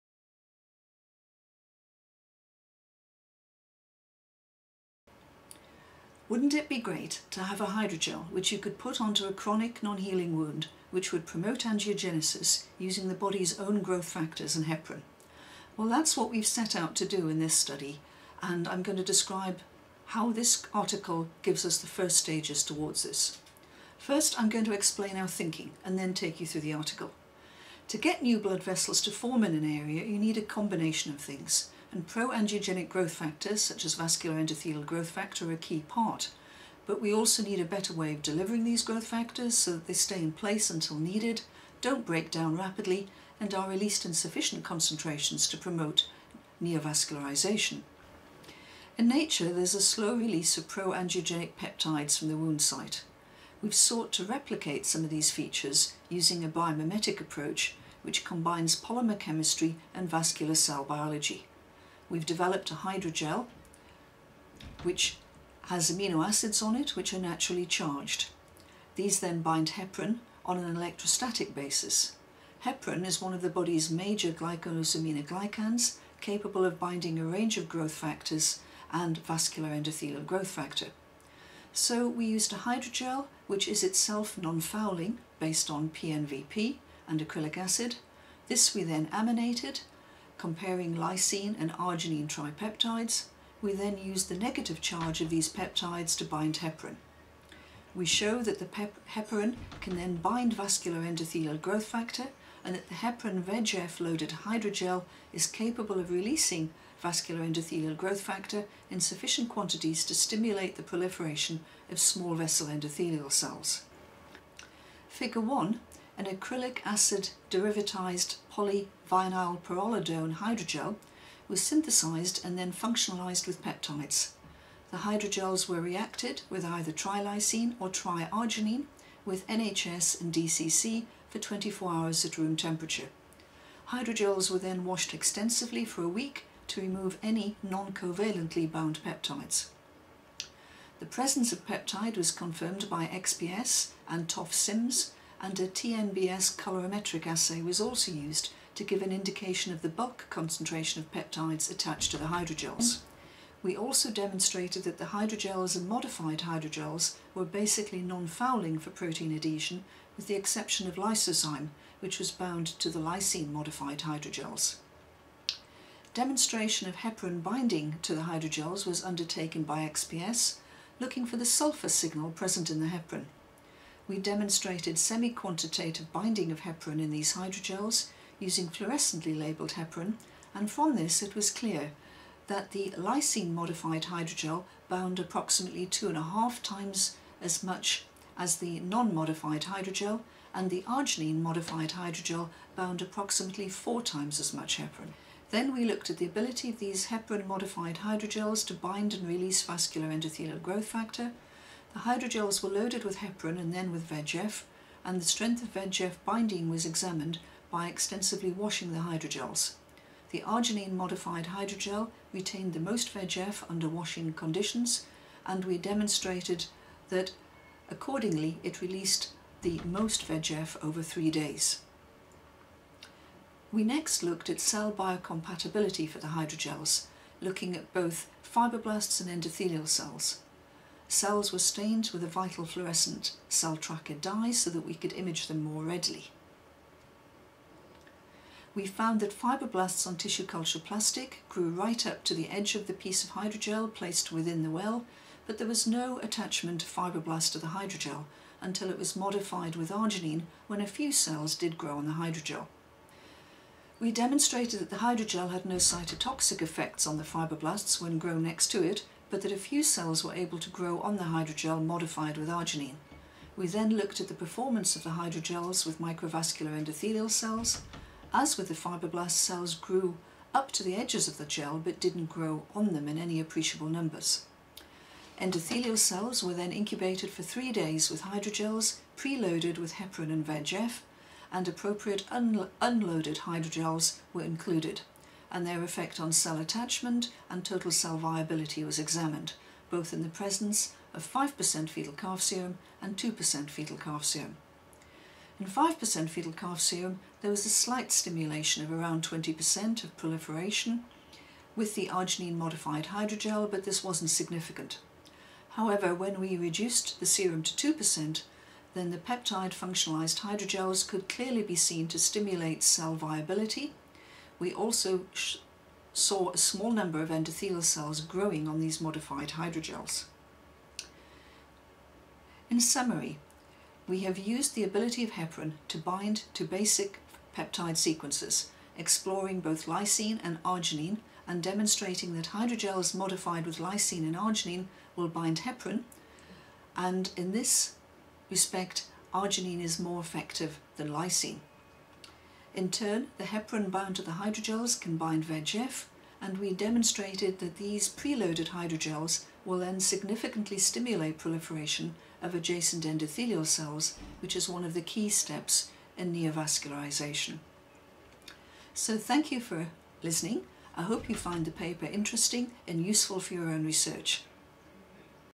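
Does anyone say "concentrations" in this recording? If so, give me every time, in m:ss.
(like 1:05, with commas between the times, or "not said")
0:44, 2:30.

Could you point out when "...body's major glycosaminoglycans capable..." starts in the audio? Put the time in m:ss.
1:13.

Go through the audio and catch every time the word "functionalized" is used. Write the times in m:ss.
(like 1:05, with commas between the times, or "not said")
2:02, 5:09.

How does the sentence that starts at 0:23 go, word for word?
First, I'm going to explain our thinking and then take you through the article.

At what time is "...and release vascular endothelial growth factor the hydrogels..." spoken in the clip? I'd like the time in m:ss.
3:19.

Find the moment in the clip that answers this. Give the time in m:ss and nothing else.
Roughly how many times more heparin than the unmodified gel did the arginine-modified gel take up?
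3:13.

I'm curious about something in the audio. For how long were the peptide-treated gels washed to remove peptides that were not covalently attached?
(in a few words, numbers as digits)
a week.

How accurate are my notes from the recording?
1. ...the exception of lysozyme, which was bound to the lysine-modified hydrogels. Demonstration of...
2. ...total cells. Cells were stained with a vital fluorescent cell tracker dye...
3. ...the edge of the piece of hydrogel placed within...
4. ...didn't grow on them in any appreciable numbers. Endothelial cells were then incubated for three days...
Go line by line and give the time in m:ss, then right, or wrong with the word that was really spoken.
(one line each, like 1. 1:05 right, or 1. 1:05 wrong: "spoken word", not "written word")
1. 2:40 right
2. 3:49 wrong: "endothelial", not "total"
3. 4:02 right
4. 4:32 right.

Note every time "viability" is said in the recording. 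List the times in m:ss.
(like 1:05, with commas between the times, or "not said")
4:48, 5:13.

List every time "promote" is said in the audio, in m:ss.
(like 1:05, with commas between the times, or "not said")
0:11, 0:45.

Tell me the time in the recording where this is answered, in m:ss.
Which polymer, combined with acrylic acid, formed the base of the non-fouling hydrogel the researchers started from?
1:25.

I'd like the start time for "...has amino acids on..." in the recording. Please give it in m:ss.
1:05.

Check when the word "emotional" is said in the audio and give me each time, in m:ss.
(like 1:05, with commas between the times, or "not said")
not said.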